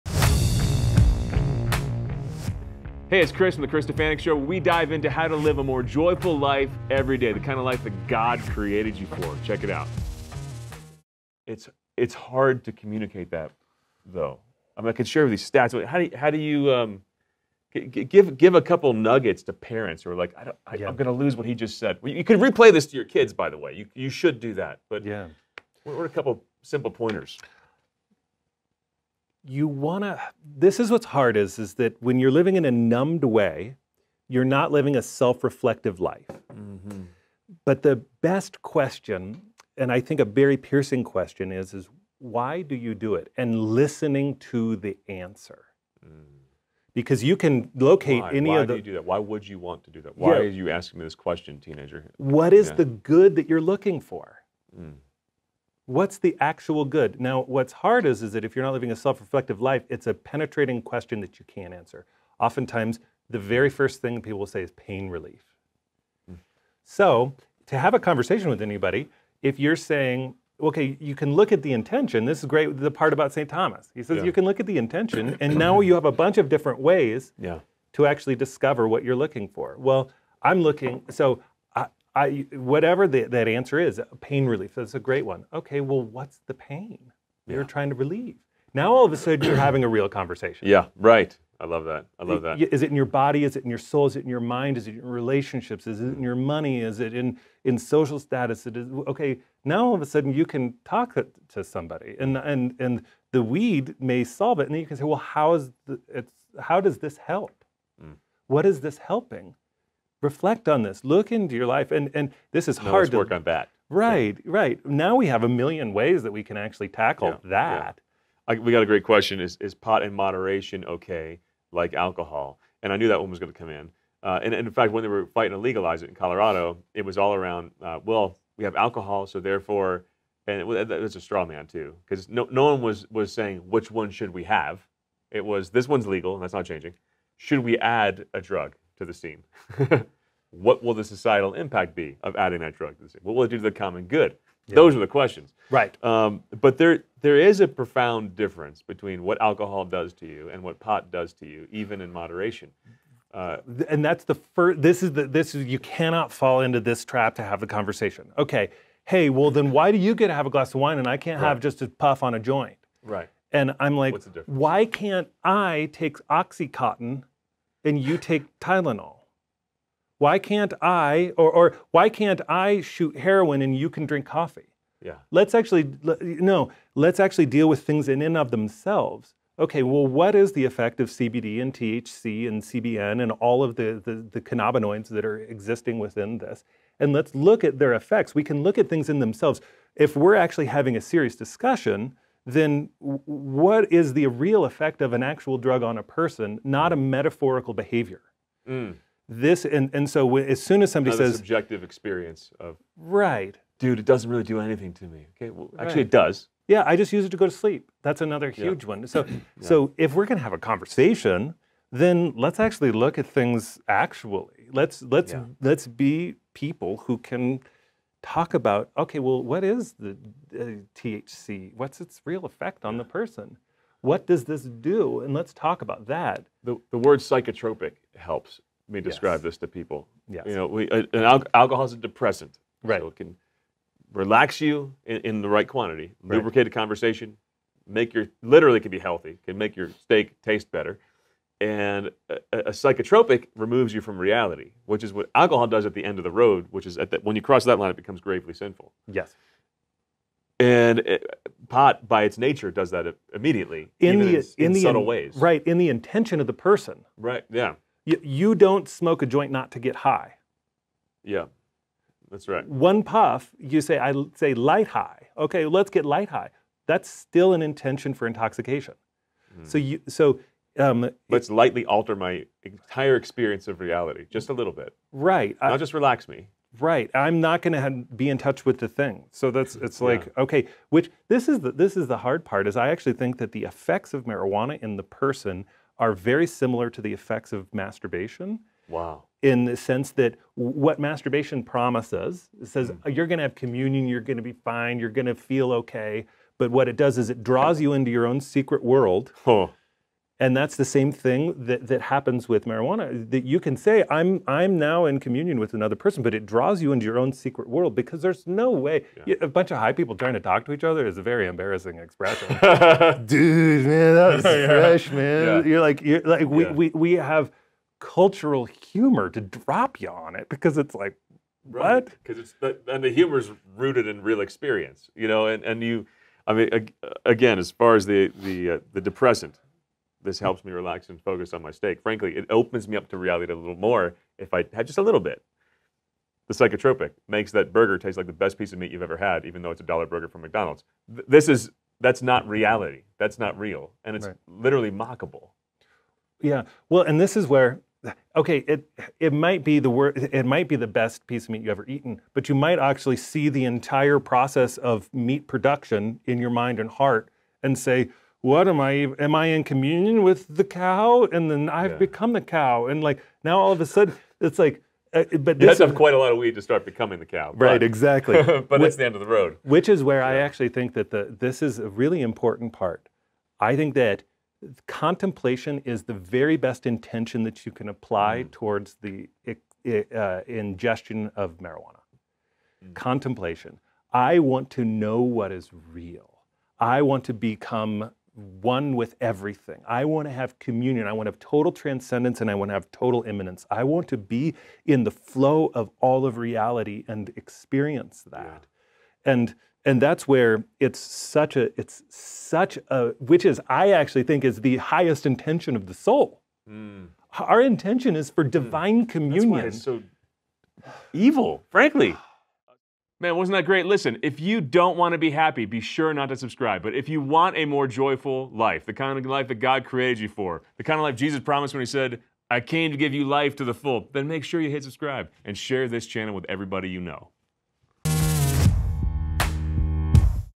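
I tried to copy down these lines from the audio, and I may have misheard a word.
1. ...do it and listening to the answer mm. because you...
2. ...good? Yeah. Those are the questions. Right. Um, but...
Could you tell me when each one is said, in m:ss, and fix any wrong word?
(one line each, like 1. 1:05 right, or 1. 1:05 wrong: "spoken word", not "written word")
1. 0:42 right
2. 2:24 right.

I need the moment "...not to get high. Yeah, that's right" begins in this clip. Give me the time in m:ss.
4:19.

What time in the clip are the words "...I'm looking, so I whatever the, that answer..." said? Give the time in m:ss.
1:20.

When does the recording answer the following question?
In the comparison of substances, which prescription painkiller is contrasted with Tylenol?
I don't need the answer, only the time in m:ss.
2:46.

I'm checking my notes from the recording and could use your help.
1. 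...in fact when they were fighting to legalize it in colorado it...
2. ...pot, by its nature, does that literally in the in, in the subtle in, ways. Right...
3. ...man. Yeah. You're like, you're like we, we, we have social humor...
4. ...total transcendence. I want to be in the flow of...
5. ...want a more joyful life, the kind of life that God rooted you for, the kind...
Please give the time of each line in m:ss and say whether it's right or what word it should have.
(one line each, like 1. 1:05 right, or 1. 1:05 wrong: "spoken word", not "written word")
1. 2:04 right
2. 4:11 wrong: "immediately", not "literally"
3. 5:15 wrong: "cultural", not "social"
4. 6:32 wrong: "immanence", not "transcendence"
5. 6:57 wrong: "created", not "rooted".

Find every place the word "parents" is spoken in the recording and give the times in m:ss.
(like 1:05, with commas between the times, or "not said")
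0:19.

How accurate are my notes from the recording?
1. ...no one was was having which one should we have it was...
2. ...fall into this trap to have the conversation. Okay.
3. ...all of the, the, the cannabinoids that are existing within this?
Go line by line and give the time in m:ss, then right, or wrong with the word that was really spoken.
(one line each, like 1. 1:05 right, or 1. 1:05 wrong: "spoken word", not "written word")
1. 2:12 wrong: "saying", not "having"
2. 2:36 right
3. 3:03 right.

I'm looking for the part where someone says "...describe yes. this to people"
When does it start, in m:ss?
3:49.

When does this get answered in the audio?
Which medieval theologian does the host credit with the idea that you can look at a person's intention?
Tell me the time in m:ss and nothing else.
1:13.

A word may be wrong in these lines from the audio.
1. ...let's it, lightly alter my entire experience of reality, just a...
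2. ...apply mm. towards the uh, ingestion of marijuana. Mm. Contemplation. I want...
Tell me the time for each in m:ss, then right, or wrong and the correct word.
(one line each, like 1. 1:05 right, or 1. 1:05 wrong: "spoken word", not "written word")
1. 4:31 right
2. 6:17 right.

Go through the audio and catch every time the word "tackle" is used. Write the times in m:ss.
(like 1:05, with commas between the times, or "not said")
1:56.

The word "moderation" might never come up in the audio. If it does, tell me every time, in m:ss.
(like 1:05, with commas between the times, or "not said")
2:00, 2:32.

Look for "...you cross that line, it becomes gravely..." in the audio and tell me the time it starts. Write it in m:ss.
4:07.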